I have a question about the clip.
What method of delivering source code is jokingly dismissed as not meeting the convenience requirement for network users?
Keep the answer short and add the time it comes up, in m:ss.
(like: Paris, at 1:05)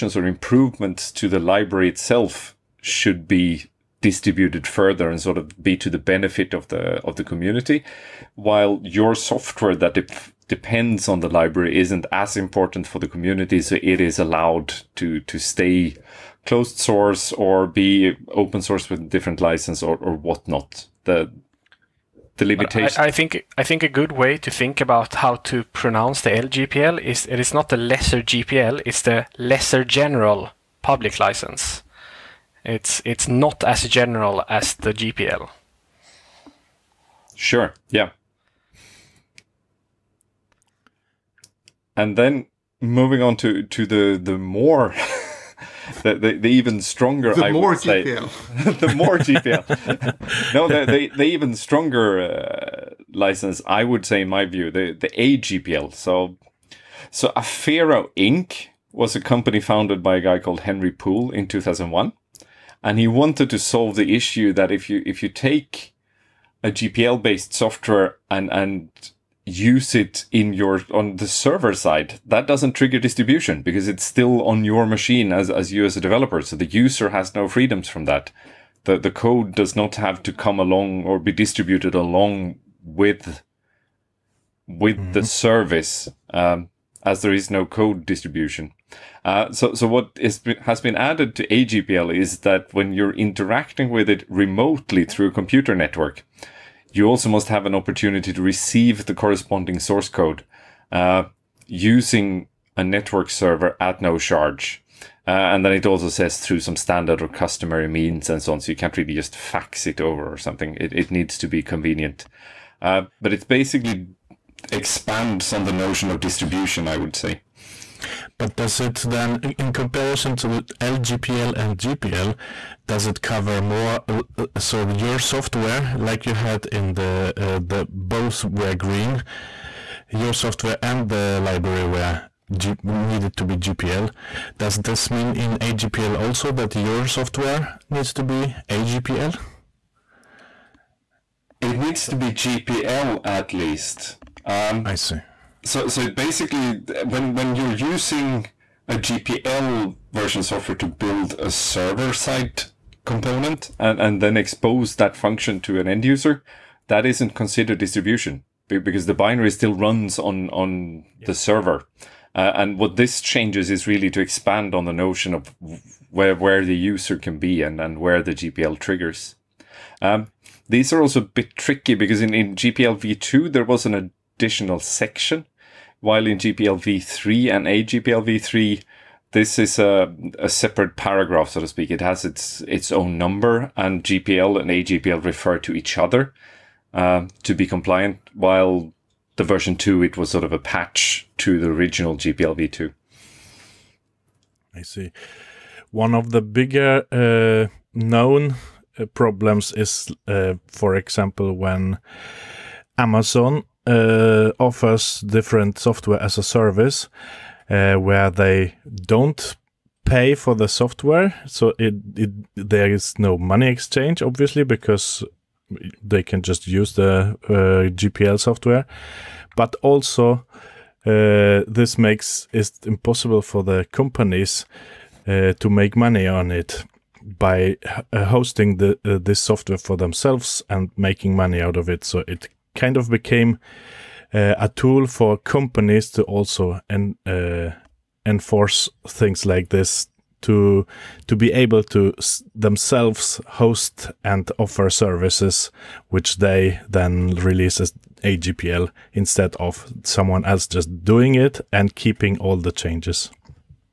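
Fax, at 1:49.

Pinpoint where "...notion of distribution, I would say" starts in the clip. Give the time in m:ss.
1:55.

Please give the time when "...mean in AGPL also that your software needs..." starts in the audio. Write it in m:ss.
2:15.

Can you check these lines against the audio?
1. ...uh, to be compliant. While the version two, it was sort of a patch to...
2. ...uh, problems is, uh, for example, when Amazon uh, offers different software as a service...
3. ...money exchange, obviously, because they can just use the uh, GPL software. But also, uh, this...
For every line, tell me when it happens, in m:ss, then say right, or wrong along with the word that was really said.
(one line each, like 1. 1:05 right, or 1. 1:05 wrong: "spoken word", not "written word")
1. 3:06 right
2. 3:18 right
3. 3:33 right.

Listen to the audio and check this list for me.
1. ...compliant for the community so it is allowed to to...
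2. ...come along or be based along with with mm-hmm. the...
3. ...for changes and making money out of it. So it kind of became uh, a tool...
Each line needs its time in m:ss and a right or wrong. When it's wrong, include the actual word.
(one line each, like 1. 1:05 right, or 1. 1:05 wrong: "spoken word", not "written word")
1. 0:12 wrong: "important", not "compliant"
2. 1:20 wrong: "distributed", not "based"
3. 3:49 wrong: "themselves", not "changes".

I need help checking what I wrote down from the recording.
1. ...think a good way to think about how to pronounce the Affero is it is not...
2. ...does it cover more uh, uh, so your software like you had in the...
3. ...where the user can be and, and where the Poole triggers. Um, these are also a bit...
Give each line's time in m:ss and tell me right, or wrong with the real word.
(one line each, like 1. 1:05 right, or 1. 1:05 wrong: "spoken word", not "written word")
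1. 0:23 wrong: "LGPL", not "Affero"
2. 2:02 right
3. 2:46 wrong: "GPL", not "Poole".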